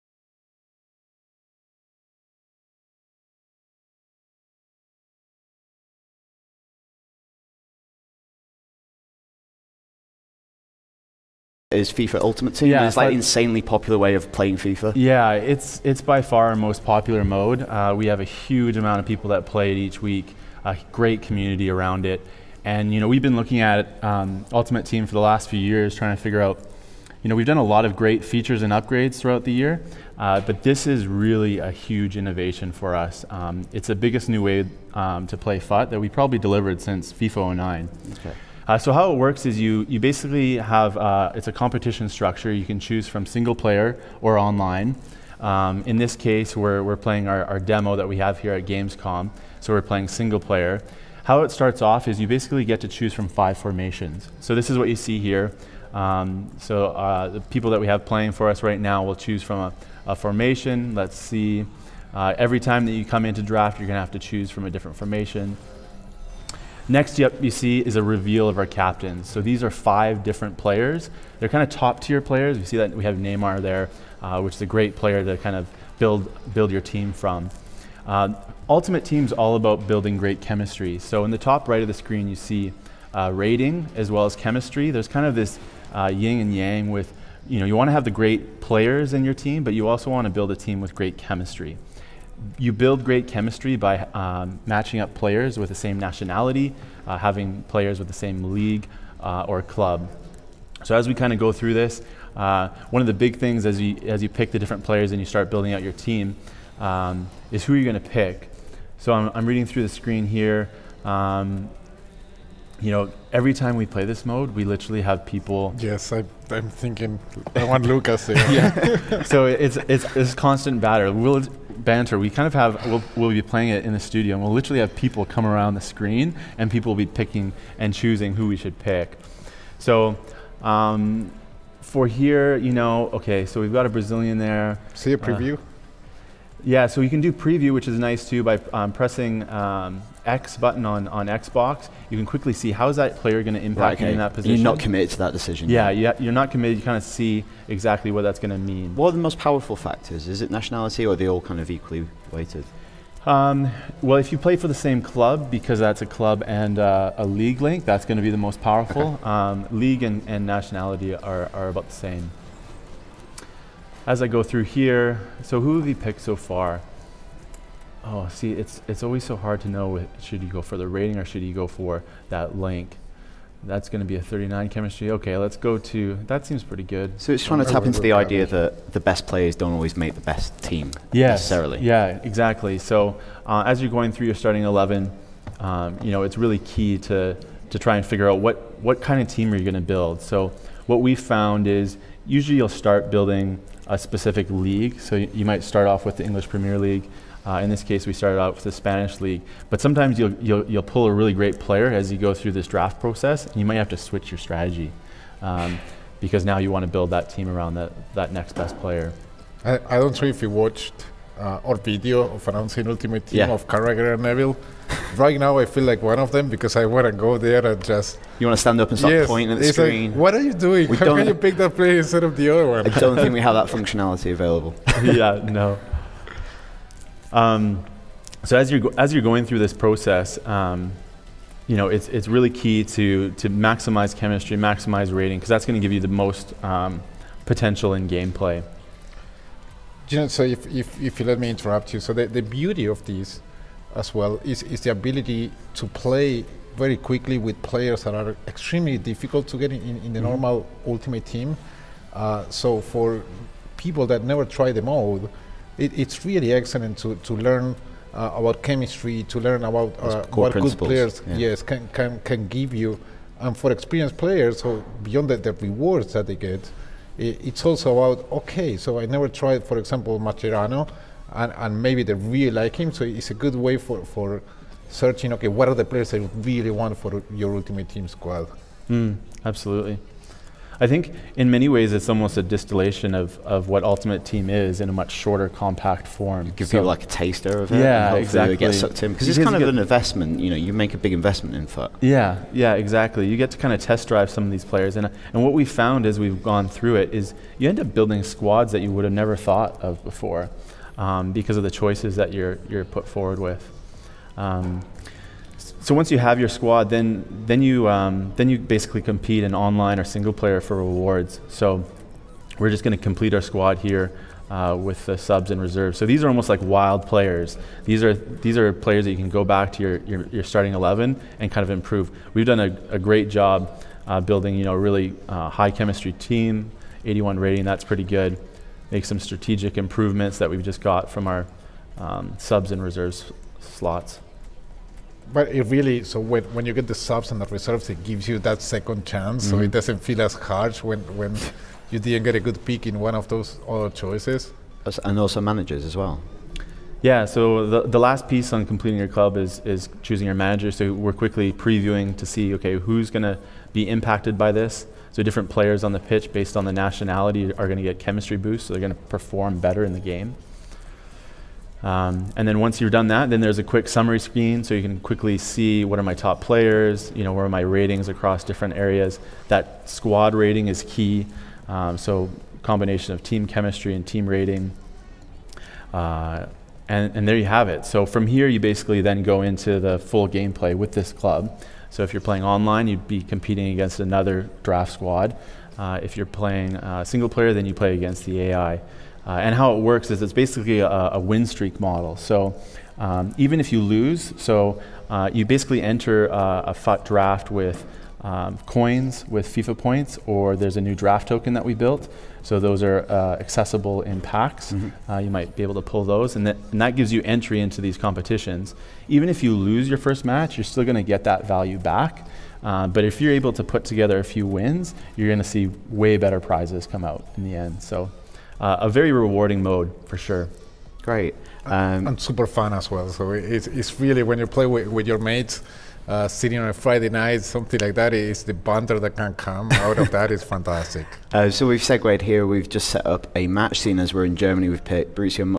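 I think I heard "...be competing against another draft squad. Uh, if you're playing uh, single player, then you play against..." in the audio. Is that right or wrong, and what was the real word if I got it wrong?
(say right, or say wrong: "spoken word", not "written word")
right.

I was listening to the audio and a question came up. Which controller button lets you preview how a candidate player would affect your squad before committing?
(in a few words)
X button.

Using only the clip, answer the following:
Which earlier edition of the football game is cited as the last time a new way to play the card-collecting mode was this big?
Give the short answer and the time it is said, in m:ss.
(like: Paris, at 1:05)
FIFA 09, at 0:37.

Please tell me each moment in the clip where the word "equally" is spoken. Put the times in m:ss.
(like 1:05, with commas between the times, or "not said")
2:31.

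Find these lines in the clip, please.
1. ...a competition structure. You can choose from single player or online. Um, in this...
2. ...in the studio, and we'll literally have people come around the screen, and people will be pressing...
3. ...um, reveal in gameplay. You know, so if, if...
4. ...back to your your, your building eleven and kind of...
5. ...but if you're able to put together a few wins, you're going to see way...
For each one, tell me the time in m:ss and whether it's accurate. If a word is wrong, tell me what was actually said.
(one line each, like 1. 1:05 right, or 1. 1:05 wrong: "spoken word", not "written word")
1. 0:41 right
2. 2:03 wrong: "picking", not "pressing"
3. 3:56 wrong: "potential", not "reveal"
4. 5:19 wrong: "starting", not "building"
5. 6:52 right.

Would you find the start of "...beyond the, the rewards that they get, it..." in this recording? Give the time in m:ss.
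4:25.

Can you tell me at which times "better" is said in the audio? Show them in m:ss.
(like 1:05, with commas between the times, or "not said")
5:59, 6:56.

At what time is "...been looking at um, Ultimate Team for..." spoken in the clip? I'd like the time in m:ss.
0:23.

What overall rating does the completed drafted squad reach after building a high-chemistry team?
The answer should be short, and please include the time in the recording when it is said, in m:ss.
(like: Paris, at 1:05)
81, at 5:27.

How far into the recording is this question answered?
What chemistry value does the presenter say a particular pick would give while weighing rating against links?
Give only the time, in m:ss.
2:54.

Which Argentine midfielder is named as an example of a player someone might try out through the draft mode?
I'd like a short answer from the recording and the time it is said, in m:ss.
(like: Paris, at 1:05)
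Mascherano, at 4:30.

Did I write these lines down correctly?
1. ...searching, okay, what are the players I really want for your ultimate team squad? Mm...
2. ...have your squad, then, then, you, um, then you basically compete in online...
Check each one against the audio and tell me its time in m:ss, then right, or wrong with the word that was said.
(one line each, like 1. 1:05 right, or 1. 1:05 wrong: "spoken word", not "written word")
1. 4:34 right
2. 5:06 right.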